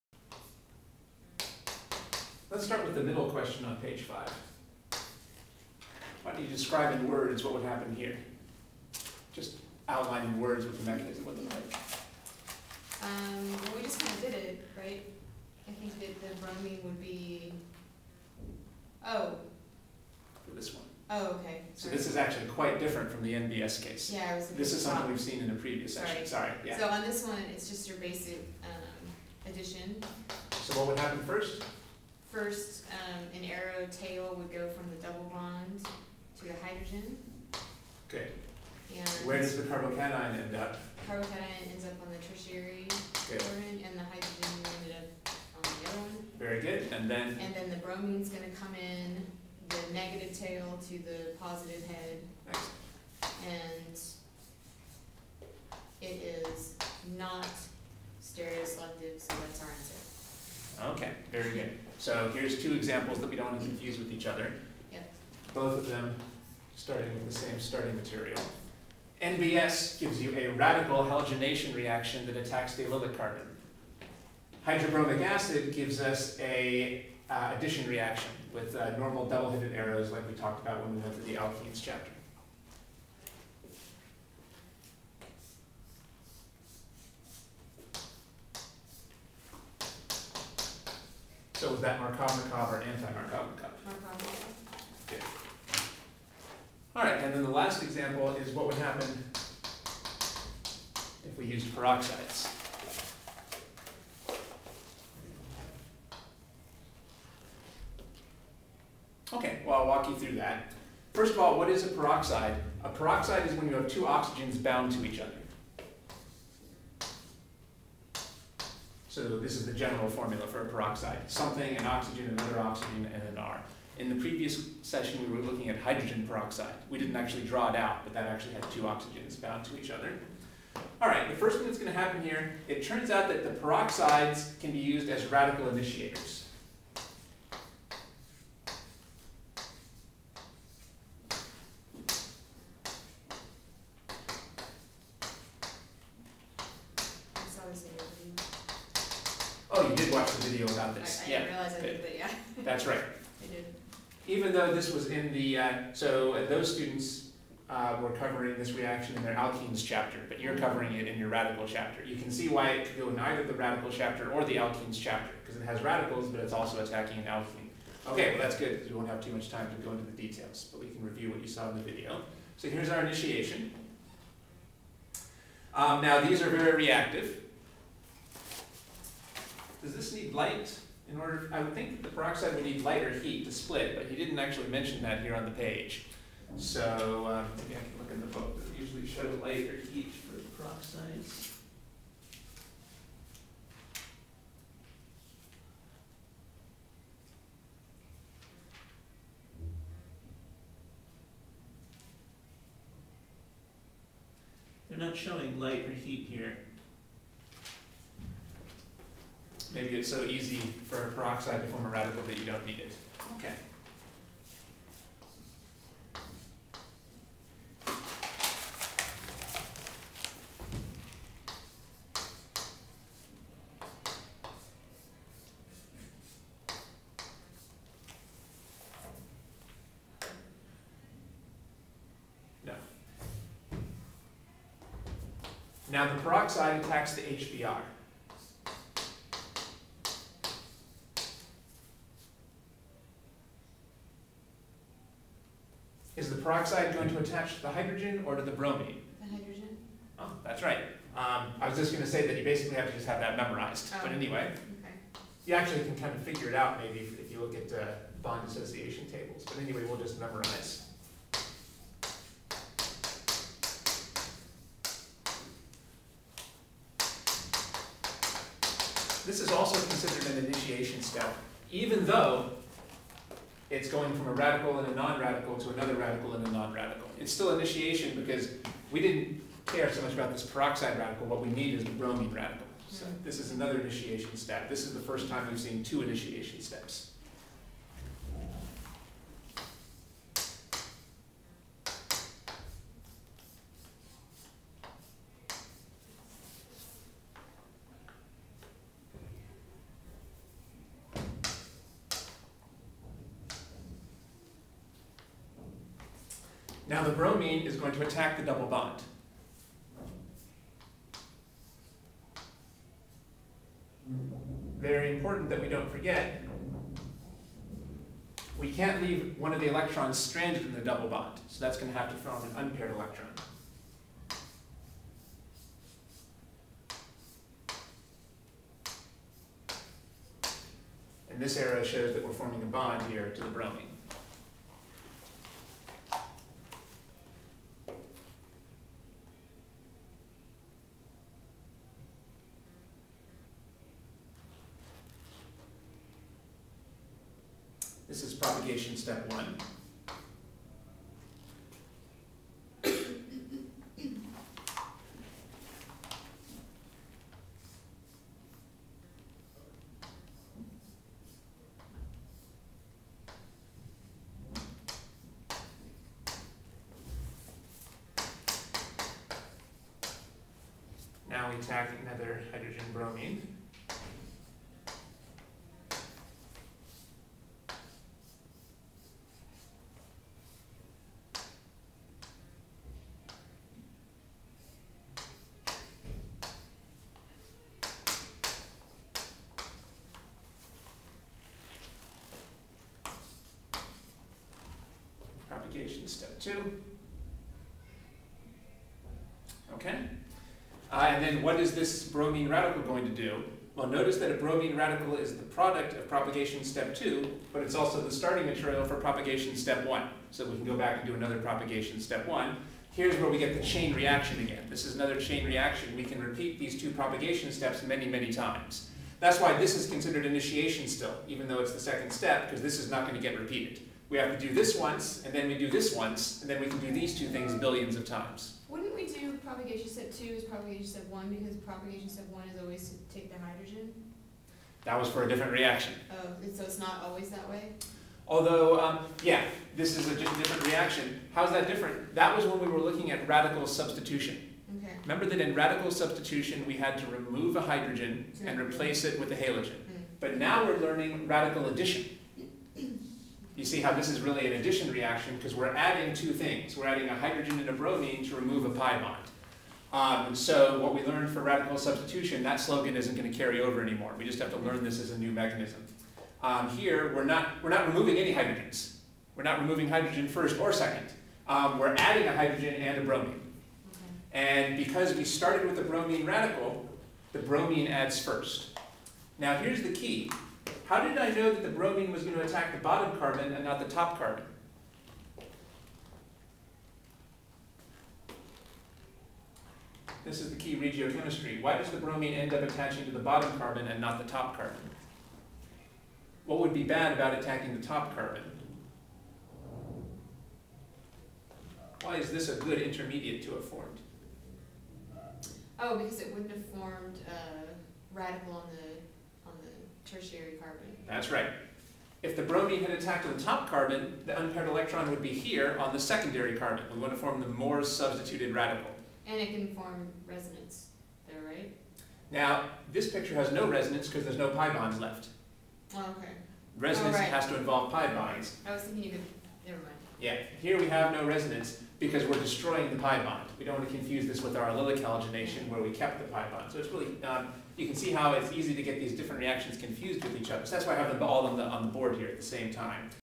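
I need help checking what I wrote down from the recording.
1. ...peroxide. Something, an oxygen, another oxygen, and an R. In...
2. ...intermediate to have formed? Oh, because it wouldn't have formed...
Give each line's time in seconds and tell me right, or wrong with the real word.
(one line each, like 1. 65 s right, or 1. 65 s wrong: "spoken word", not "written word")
1. 120 s right
2. 502 s right.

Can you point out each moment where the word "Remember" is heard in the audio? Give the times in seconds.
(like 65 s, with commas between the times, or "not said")
445 s.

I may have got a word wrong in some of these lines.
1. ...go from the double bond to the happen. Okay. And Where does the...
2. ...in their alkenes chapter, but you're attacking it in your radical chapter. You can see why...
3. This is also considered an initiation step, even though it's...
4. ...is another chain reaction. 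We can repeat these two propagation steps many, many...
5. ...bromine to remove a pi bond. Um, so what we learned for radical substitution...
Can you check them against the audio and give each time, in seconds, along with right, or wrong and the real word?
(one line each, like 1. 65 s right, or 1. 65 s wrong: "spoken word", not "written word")
1. 34 s wrong: "hydrogen", not "happen"
2. 159 s wrong: "covering", not "attacking"
3. 269 s right
4. 414 s right
5. 457 s right.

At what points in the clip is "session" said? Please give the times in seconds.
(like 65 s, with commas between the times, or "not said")
26 s, 124 s.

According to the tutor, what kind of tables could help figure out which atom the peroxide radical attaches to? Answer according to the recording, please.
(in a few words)
Bond dissociation tables.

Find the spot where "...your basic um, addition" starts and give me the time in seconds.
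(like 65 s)
27 s.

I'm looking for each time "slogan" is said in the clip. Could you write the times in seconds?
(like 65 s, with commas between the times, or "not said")
462 s.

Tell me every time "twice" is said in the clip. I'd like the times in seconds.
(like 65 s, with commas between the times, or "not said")
not said.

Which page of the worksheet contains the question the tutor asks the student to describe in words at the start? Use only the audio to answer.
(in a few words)
Page five.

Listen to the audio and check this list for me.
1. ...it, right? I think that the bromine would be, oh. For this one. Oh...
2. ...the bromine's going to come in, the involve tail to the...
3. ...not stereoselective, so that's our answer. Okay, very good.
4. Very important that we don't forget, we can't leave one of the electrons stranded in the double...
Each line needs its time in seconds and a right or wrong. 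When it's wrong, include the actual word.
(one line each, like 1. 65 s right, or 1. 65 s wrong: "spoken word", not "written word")
1. 14 s right
2. 47 s wrong: "negative", not "involve"
3. 57 s right
4. 314 s right.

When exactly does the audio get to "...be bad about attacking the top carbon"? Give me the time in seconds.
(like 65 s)
496 s.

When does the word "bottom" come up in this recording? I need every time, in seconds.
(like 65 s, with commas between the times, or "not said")
482 s, 493 s.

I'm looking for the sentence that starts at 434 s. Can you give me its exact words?
That was for a different reaction.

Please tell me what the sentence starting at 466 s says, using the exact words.
Um, here, we're not, we're not removing any hydrogens.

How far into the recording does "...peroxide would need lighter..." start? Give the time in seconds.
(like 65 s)
182 s.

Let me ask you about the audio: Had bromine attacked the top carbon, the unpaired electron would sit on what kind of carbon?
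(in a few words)
Secondary carbon.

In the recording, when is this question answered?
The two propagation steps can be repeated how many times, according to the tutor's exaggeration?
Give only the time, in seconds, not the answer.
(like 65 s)
427 s.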